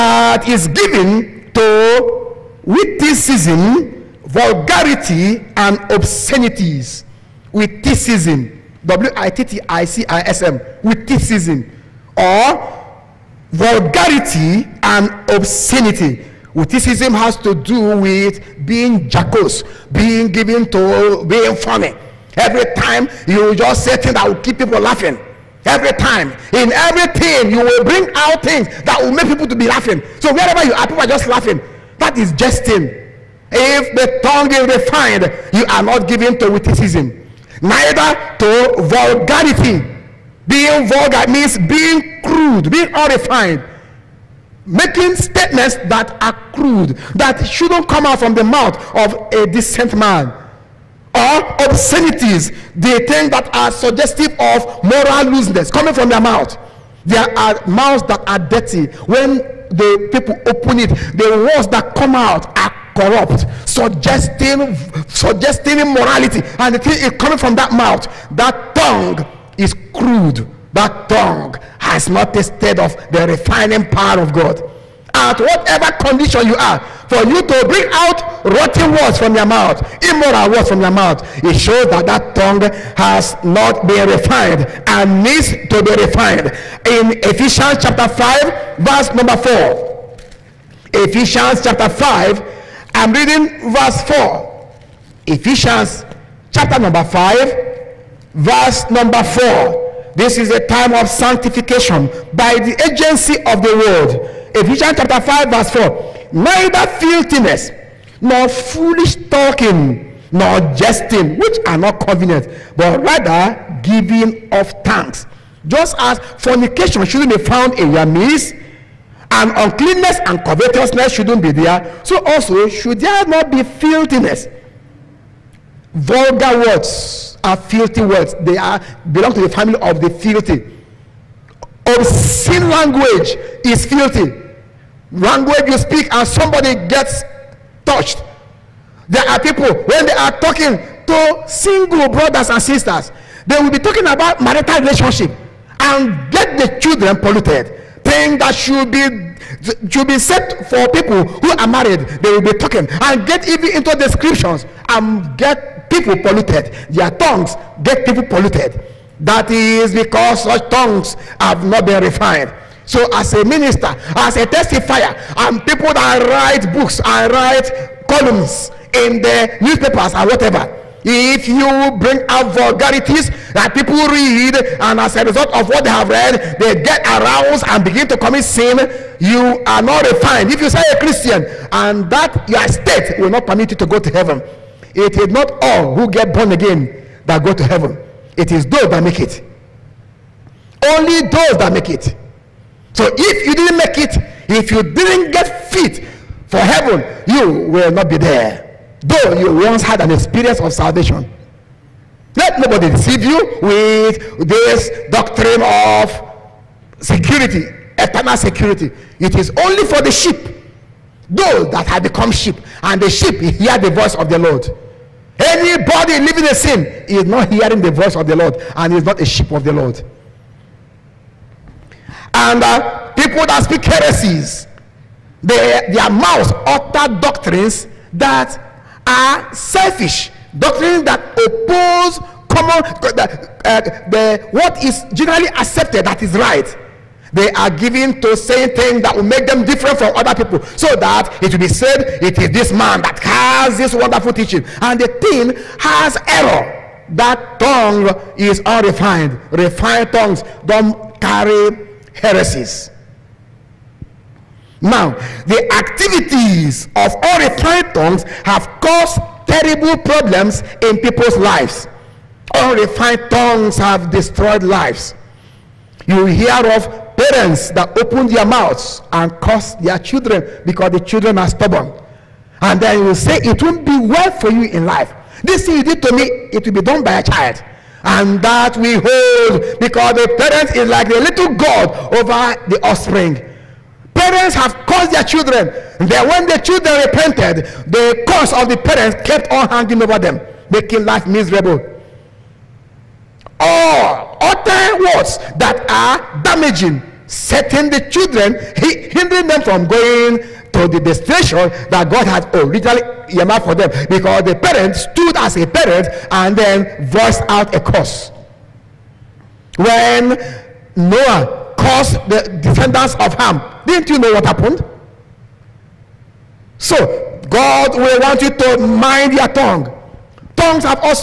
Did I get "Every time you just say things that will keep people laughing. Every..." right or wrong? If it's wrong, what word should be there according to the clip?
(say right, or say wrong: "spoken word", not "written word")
right.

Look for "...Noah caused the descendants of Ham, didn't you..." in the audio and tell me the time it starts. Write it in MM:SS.
05:10.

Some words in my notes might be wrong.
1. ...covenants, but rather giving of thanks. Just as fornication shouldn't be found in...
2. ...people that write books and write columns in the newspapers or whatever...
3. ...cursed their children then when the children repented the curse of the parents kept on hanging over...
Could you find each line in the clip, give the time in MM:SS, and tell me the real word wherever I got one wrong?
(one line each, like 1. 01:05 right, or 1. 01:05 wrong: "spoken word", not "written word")
1. 01:52 right
2. 02:45 right
3. 04:44 right.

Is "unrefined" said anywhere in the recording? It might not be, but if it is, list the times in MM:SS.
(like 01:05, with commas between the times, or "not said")
00:42, 04:08, 04:22.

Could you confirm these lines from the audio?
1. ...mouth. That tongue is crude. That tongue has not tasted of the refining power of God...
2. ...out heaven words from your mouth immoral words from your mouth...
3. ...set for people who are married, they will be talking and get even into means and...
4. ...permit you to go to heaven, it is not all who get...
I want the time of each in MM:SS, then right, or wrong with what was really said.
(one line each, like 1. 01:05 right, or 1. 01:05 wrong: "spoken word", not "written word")
1. 01:07 right
2. 01:17 wrong: "rotten", not "heaven"
3. 02:30 wrong: "descriptions", not "means"
4. 03:03 right.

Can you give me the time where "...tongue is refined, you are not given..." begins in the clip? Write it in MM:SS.
00:34.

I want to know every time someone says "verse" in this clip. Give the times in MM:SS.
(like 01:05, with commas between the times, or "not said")
01:28, 01:33, 01:38, 01:45.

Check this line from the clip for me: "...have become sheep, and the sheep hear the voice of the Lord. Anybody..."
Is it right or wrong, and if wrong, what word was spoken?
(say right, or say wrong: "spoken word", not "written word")
right.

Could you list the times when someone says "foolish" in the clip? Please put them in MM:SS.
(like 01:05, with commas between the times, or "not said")
01:48.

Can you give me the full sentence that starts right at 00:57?
There are mouths that are dirty.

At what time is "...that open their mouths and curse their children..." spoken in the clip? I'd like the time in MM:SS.
04:27.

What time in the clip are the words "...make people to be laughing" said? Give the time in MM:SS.
00:29.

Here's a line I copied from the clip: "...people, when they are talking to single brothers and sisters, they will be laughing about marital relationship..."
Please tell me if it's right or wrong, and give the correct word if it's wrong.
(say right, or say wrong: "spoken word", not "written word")
wrong: "talking", not "laughing".